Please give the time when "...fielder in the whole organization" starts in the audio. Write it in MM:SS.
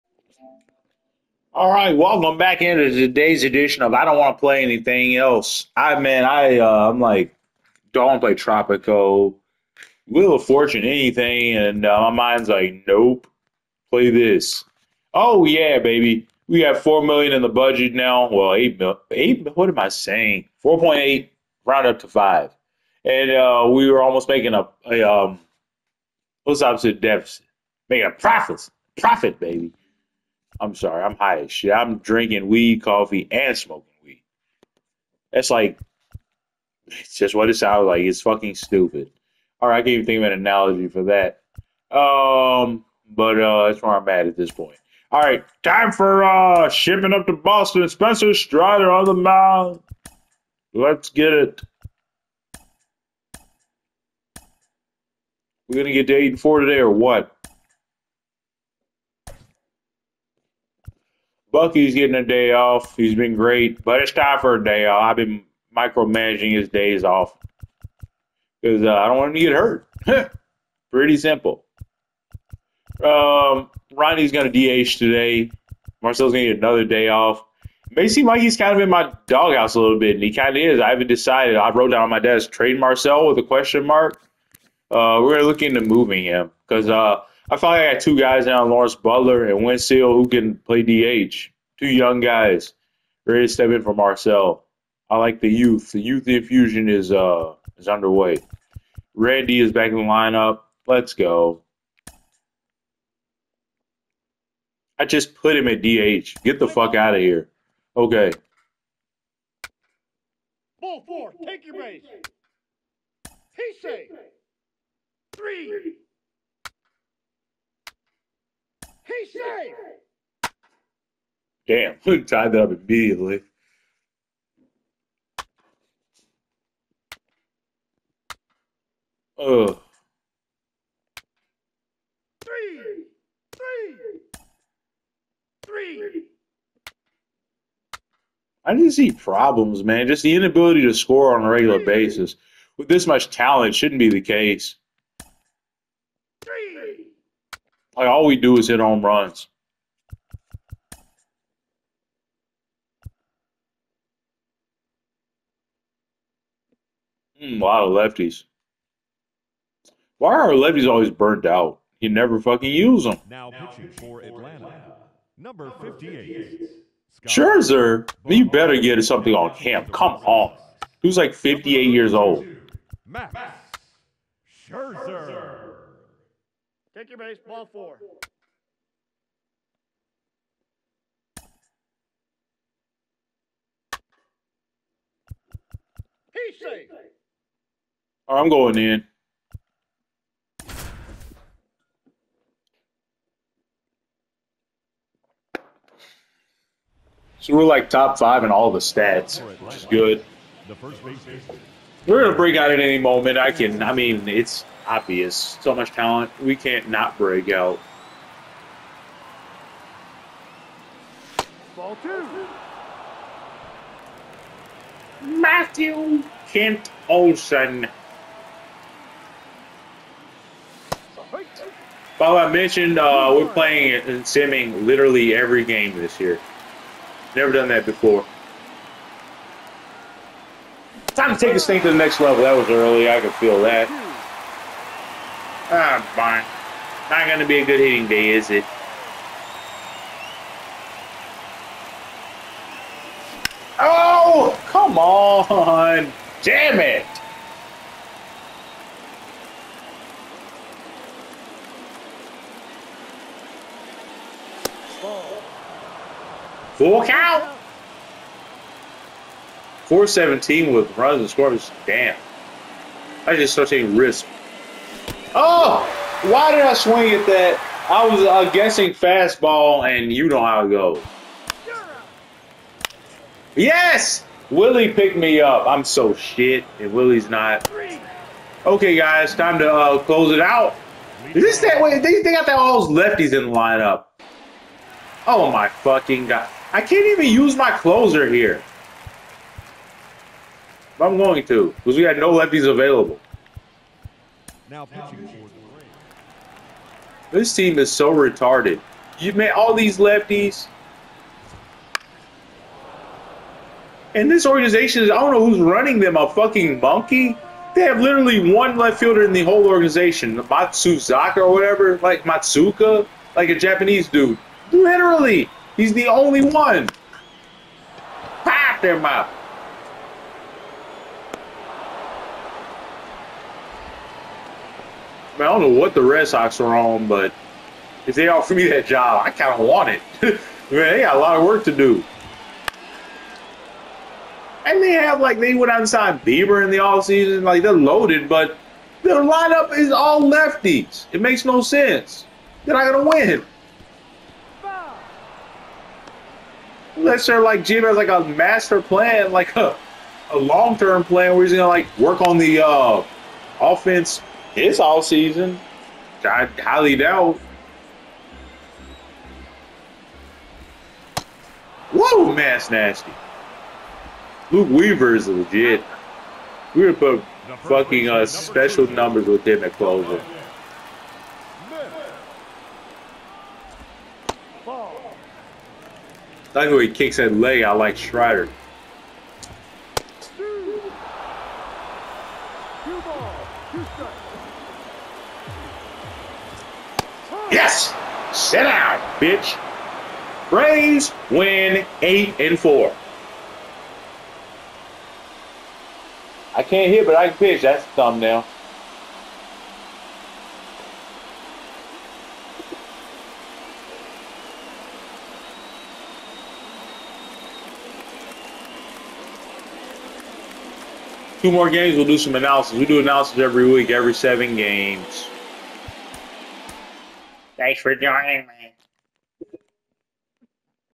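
05:08.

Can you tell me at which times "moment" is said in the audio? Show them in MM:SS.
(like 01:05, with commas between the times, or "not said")
03:22.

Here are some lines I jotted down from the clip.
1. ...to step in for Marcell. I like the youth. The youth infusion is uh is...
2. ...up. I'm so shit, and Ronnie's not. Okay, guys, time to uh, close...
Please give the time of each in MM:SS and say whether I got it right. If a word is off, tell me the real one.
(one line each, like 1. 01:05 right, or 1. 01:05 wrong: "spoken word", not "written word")
1. 01:33 right
2. 04:35 wrong: "Willie", not "Ronnie".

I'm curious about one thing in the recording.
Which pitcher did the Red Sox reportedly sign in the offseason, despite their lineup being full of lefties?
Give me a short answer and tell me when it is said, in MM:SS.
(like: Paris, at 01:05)
Bieber, at 05:36.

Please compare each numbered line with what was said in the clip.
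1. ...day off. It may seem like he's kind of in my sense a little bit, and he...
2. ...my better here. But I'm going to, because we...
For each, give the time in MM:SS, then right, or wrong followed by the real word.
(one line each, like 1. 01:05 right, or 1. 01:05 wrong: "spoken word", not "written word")
1. 01:16 wrong: "doghouse", not "sense"
2. 04:47 wrong: "closer", not "better".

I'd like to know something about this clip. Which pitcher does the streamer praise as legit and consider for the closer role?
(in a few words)
Luke Weaver.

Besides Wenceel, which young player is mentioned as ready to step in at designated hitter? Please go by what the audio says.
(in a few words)
Lawrence Butler.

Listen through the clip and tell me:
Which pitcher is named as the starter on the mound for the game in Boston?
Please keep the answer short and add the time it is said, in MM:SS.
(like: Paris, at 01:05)
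Spencer Strider, at 00:47.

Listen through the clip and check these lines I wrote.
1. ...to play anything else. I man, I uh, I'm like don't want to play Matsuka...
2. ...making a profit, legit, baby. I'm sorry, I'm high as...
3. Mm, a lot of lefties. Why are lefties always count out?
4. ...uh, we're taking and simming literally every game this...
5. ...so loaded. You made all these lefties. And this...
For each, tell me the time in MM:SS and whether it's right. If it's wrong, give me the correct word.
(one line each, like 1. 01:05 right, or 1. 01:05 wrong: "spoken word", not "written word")
1. 00:04 wrong: "Tropico", not "Matsuka"
2. 00:27 wrong: "profit", not "legit"
3. 02:37 wrong: "burnt", not "count"
4. 03:42 wrong: "playing", not "taking"
5. 04:57 wrong: "retarded", not "loaded".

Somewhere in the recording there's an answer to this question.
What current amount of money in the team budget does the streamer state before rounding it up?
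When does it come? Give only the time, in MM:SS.
00:20.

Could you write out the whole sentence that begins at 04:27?
I was uh, guessing fastball, and you know how it goes.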